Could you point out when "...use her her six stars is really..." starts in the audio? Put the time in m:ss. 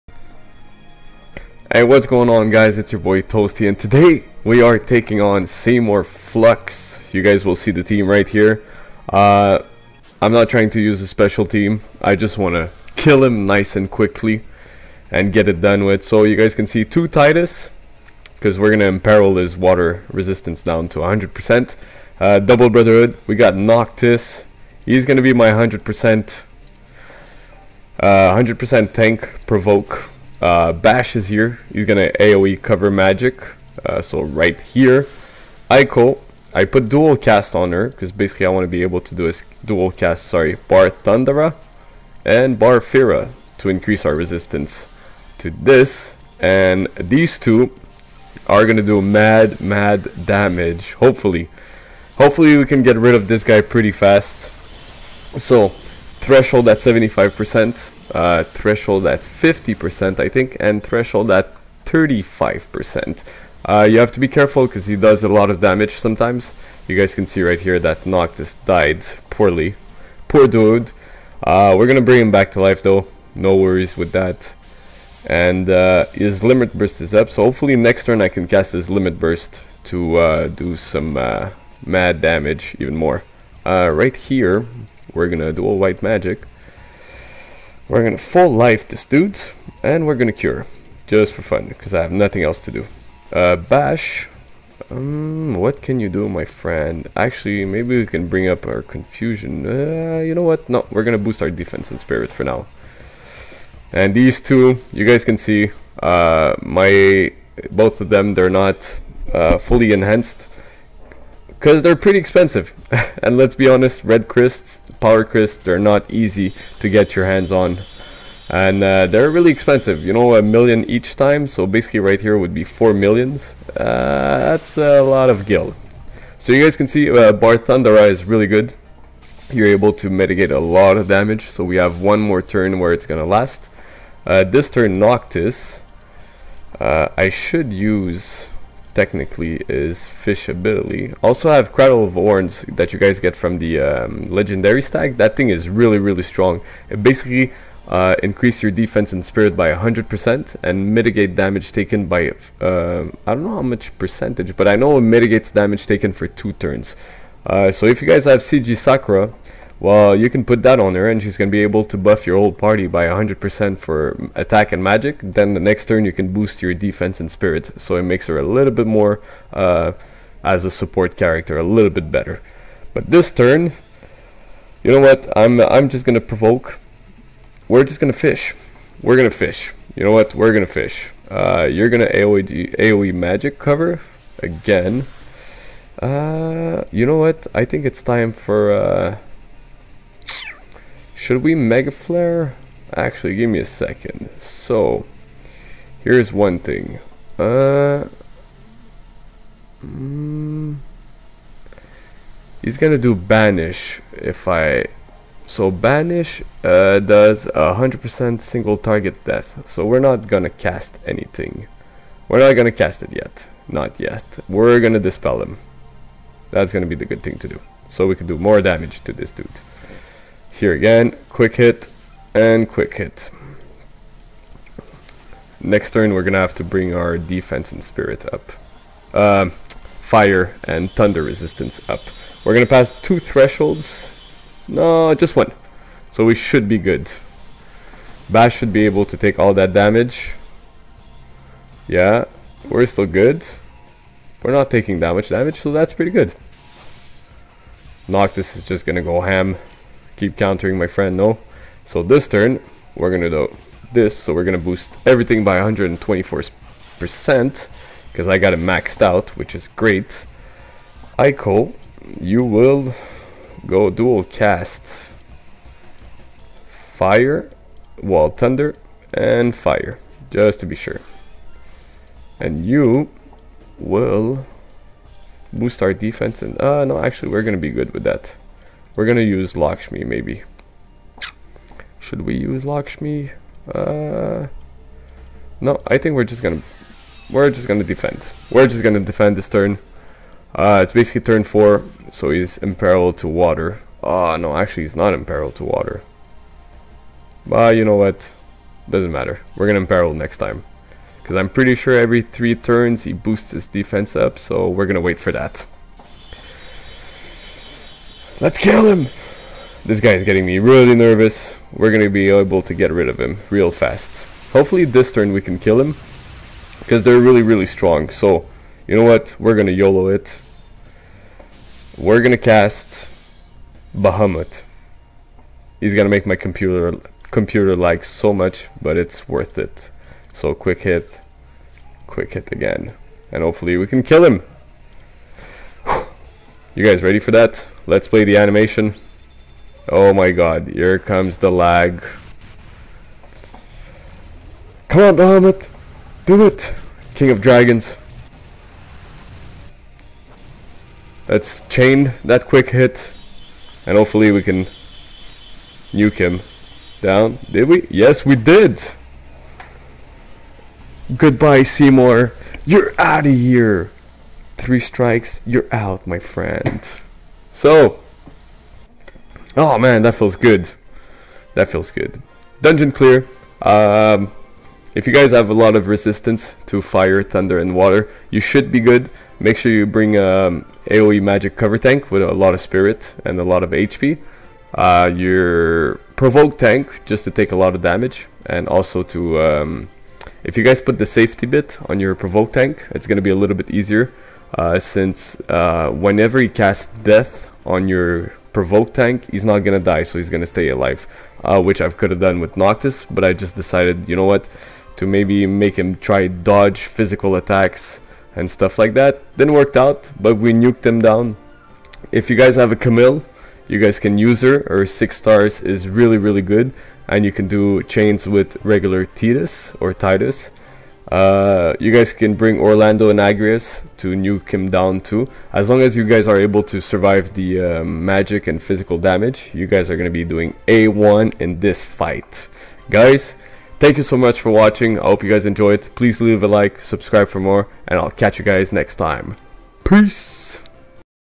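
6:54.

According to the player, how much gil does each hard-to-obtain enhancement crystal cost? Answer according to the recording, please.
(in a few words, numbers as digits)
A million.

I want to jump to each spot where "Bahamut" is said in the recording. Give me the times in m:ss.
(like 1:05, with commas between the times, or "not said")
5:23, 5:45.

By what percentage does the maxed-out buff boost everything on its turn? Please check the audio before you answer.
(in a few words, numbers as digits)
124%.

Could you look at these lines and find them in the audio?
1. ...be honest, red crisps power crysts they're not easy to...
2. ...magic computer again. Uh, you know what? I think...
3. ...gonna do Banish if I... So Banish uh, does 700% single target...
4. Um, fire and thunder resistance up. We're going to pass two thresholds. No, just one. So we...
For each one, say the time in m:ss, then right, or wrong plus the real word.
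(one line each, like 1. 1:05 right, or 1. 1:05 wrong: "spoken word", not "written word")
1. 1:53 right
2. 3:03 wrong: "cover", not "computer"
3. 3:22 wrong: "100", not "700"
4. 3:49 right.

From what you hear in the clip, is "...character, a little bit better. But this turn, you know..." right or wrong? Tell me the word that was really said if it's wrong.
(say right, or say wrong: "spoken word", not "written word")
right.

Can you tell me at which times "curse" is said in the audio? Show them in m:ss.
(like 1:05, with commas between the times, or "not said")
not said.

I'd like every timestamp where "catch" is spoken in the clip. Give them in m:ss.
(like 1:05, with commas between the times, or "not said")
7:18.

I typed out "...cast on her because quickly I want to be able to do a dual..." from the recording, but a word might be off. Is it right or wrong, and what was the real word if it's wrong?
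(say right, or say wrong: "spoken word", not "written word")
wrong: "basically", not "quickly".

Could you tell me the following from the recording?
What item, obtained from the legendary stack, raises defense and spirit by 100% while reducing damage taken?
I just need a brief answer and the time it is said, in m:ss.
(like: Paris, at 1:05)
Cradle of Horns, at 2:21.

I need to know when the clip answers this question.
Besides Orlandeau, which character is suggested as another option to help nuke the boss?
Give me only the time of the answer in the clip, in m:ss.
7:03.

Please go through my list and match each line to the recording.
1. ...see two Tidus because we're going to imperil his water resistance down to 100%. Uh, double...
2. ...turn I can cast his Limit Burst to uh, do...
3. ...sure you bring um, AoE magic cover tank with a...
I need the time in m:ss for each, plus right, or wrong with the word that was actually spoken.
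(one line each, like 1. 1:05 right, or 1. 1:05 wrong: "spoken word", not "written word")
1. 0:16 right
2. 1:18 right
3. 6:19 right.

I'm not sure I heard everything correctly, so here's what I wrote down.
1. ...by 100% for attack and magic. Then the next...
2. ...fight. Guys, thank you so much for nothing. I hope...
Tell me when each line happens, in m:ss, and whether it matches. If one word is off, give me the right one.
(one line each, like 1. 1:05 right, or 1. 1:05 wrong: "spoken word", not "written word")
1. 2:42 right
2. 7:11 wrong: "watching", not "nothing".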